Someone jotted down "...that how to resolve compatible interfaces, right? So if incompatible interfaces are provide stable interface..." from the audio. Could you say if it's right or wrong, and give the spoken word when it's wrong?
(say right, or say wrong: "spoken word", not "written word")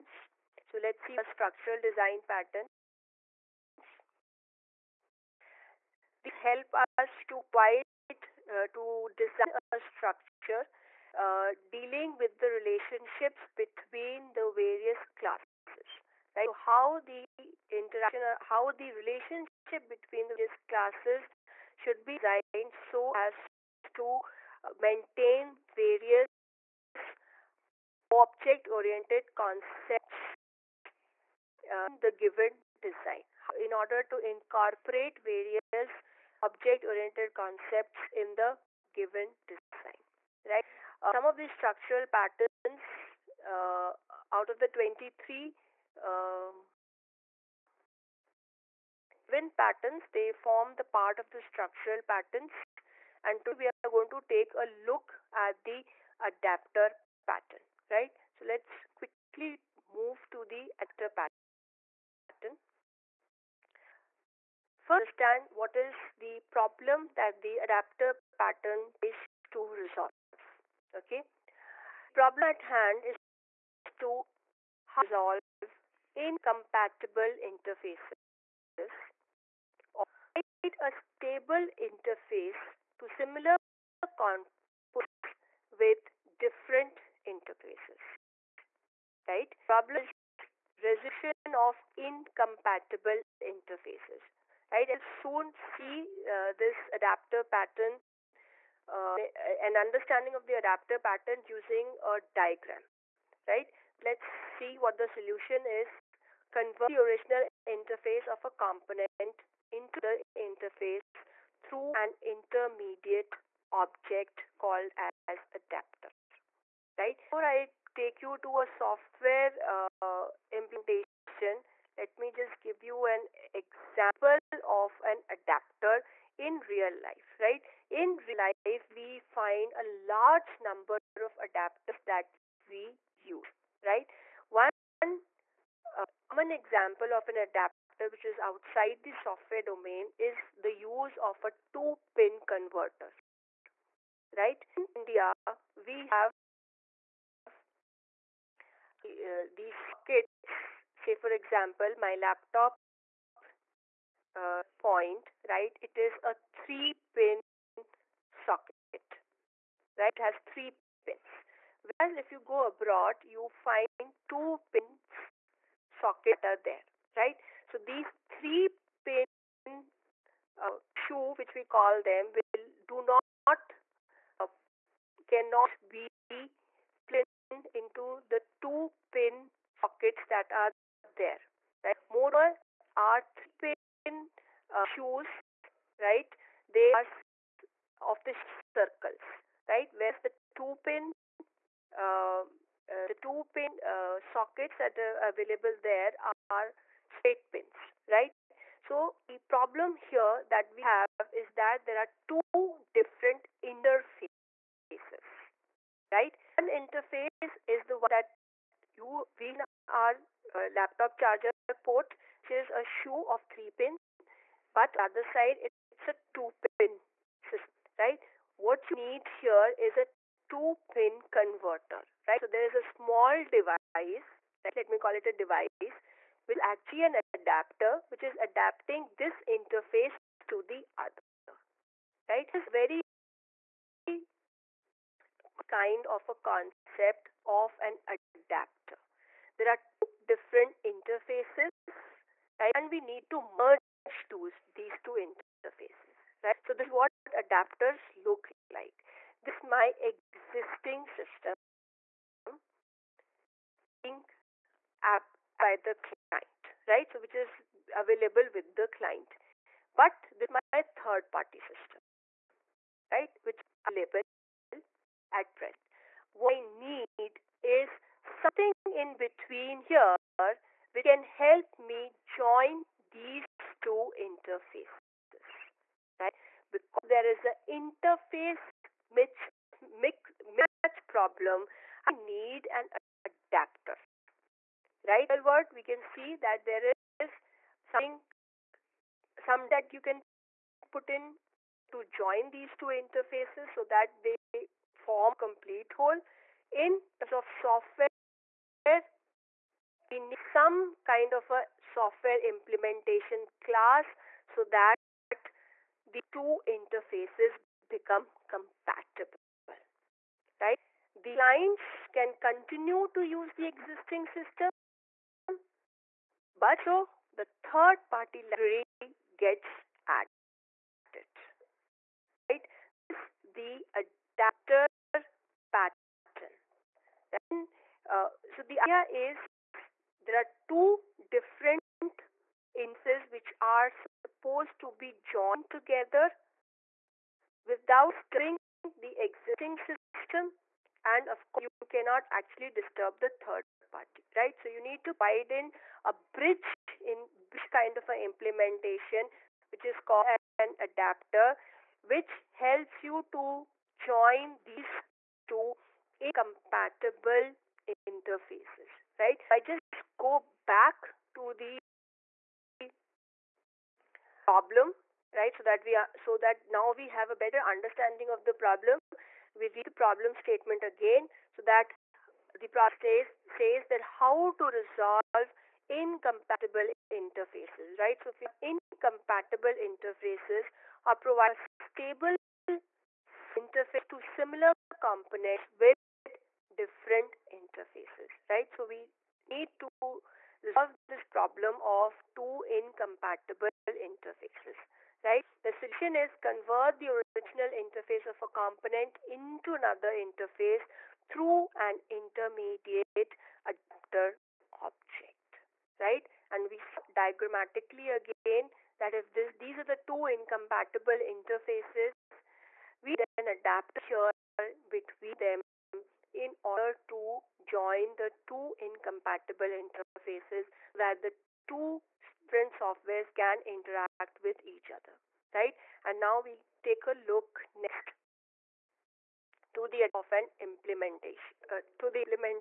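wrong: "incompatible", not "compatible".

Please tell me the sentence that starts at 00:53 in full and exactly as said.
And today we are going to take a look at the adapter pattern, right?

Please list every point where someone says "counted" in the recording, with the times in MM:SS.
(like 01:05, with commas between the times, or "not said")
not said.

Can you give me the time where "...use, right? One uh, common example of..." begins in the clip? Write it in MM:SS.
02:13.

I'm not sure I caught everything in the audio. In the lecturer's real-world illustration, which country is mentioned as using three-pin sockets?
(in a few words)
India.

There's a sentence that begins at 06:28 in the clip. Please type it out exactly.
So we need to resolve this problem of two incompatible interfaces, right?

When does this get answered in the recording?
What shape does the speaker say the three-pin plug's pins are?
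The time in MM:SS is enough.
03:08.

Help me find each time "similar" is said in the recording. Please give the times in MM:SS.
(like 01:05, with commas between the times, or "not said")
01:23, 06:24.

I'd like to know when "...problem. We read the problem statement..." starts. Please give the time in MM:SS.
06:08.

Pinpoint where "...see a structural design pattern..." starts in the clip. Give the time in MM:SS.
00:01.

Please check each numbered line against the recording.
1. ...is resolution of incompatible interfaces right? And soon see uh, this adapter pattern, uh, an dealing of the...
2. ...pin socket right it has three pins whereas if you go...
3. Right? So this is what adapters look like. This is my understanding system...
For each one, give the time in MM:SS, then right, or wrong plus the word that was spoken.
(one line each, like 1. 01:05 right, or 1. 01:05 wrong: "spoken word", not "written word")
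1. 01:30 wrong: "understanding", not "dealing"
2. 02:37 right
3. 04:06 wrong: "existing", not "understanding".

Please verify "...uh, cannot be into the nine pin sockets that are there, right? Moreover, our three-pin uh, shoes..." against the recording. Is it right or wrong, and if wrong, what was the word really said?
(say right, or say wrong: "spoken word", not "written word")
wrong: "two", not "nine".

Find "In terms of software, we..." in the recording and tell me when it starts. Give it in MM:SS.
04:56.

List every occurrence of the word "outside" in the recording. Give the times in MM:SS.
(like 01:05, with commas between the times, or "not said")
02:18.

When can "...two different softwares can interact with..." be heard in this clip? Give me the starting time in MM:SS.
07:01.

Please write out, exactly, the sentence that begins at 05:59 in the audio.
I just go back to the problem, right?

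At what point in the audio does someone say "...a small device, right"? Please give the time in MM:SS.
03:42.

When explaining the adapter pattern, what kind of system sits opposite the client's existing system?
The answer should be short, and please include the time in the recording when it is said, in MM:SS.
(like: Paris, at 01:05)
third party system, at 04:21.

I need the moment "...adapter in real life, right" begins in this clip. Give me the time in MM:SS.
02:05.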